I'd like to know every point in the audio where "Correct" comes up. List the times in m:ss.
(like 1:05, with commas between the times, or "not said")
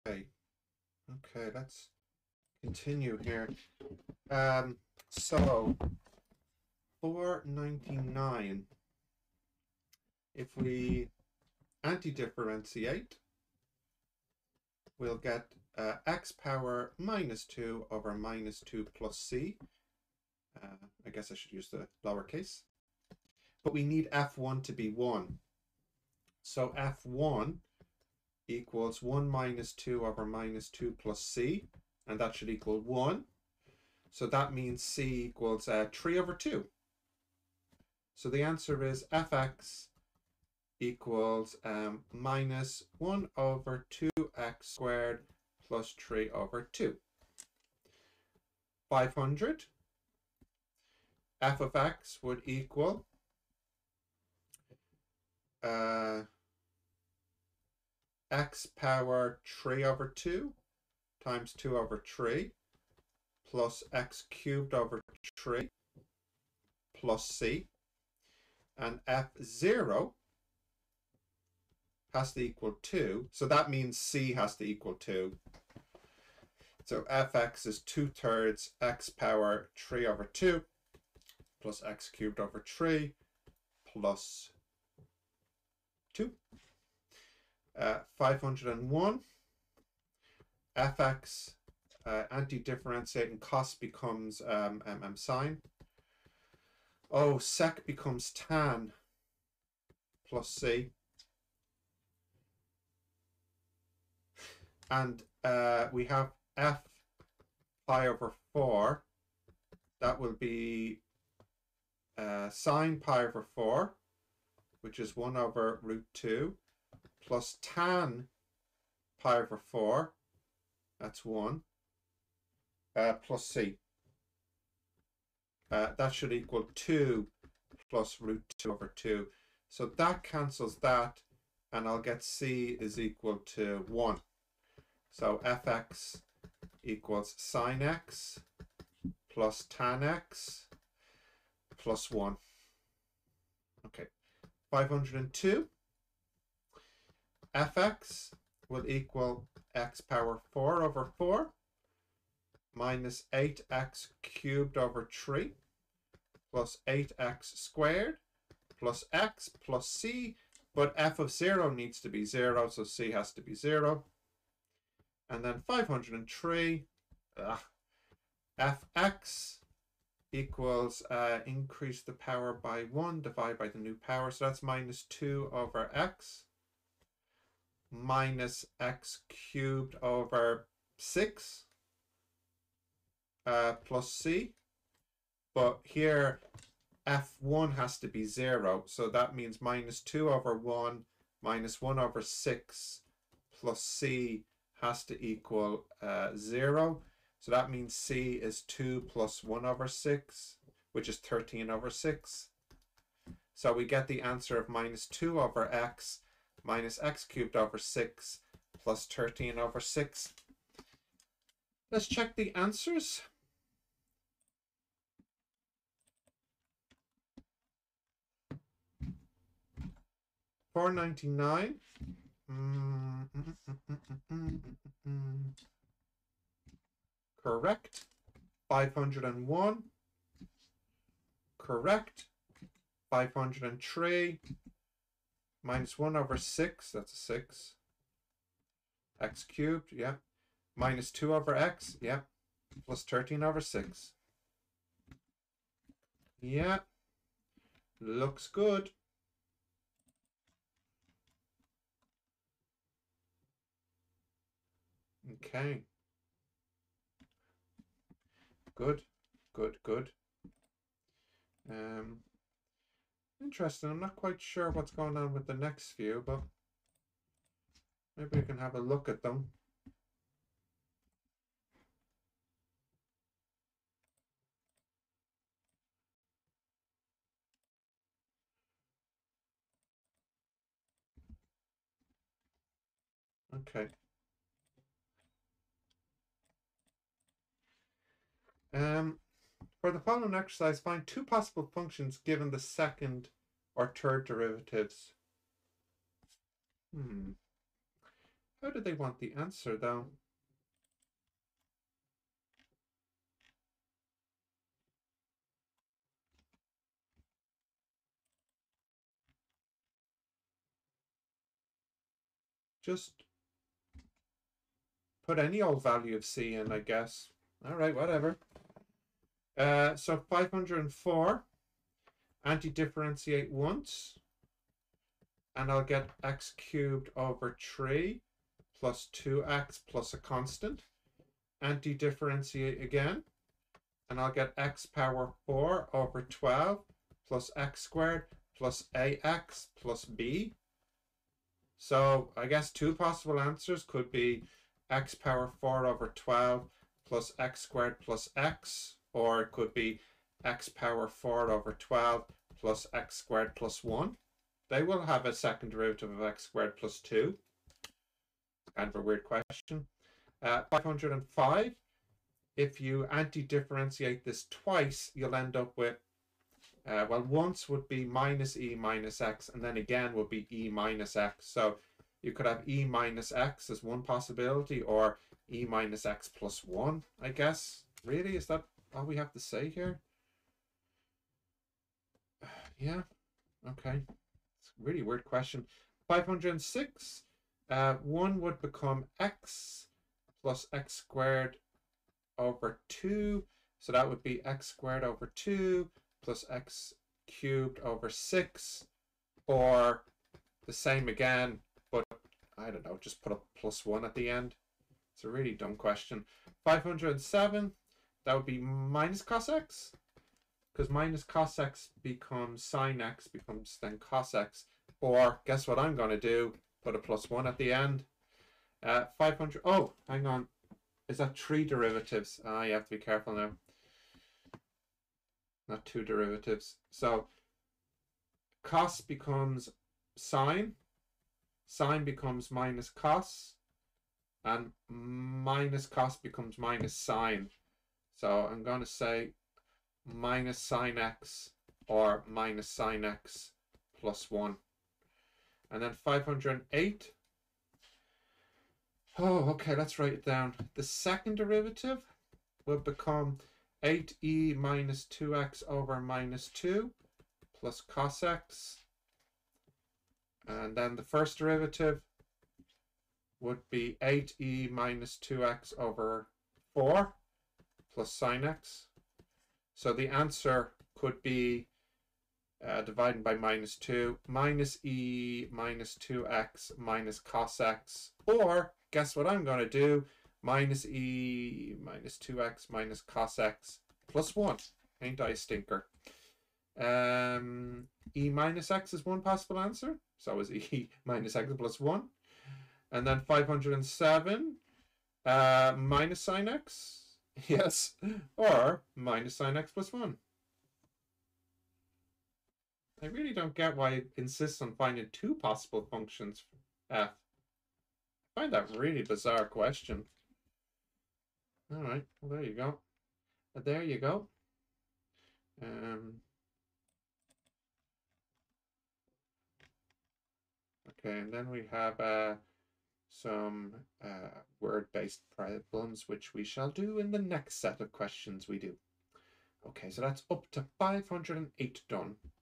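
3:47, 3:51.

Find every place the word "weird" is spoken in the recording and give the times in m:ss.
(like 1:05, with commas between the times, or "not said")
5:59, 6:25.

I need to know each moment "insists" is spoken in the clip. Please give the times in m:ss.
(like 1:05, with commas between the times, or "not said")
8:24.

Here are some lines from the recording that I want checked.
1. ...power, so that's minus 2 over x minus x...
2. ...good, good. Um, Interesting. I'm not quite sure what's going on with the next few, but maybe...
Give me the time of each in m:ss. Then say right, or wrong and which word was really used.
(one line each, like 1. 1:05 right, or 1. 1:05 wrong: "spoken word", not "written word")
1. 2:54 right
2. 4:19 right.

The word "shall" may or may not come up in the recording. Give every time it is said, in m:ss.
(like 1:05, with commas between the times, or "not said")
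8:46.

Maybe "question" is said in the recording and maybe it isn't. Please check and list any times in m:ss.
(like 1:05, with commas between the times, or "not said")
5:59, 6:25, 6:45, 8:29, 8:47.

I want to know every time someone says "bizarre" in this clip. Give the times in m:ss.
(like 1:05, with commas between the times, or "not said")
8:29.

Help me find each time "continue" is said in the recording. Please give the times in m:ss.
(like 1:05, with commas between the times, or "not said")
0:02.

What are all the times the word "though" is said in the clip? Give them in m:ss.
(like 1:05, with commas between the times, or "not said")
4:59.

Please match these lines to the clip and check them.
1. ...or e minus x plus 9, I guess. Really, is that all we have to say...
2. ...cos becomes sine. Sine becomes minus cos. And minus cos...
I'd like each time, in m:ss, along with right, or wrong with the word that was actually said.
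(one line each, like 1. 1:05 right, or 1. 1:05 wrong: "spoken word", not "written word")
1. 6:14 wrong: "1", not "9"
2. 7:08 right.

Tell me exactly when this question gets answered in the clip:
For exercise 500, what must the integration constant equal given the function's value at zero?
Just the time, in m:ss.
1:13.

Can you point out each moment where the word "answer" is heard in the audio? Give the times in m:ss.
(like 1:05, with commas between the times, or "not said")
0:38, 3:24, 3:32, 4:59, 5:43, 7:50, 8:09.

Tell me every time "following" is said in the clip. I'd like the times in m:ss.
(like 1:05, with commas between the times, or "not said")
4:49.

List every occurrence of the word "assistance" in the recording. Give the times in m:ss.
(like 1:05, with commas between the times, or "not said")
not said.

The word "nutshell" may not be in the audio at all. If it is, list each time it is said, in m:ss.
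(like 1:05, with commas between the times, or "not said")
not said.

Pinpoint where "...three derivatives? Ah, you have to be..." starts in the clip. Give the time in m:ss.
7:01.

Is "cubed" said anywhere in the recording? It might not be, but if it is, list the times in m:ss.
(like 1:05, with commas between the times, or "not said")
1:04, 1:22, 2:34, 2:59, 3:27, 3:59, 5:26, 6:37.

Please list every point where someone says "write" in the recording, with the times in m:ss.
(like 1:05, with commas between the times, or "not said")
7:29.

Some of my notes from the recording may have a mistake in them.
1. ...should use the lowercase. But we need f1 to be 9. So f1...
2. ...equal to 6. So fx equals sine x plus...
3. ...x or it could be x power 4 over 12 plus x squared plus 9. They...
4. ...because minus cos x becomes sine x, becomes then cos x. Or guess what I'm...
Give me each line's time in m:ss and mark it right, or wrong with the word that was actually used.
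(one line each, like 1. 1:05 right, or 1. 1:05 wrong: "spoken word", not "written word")
1. 0:21 wrong: "1", not "9"
2. 2:12 wrong: "1", not "6"
3. 5:48 wrong: "1", not "9"
4. 6:50 right.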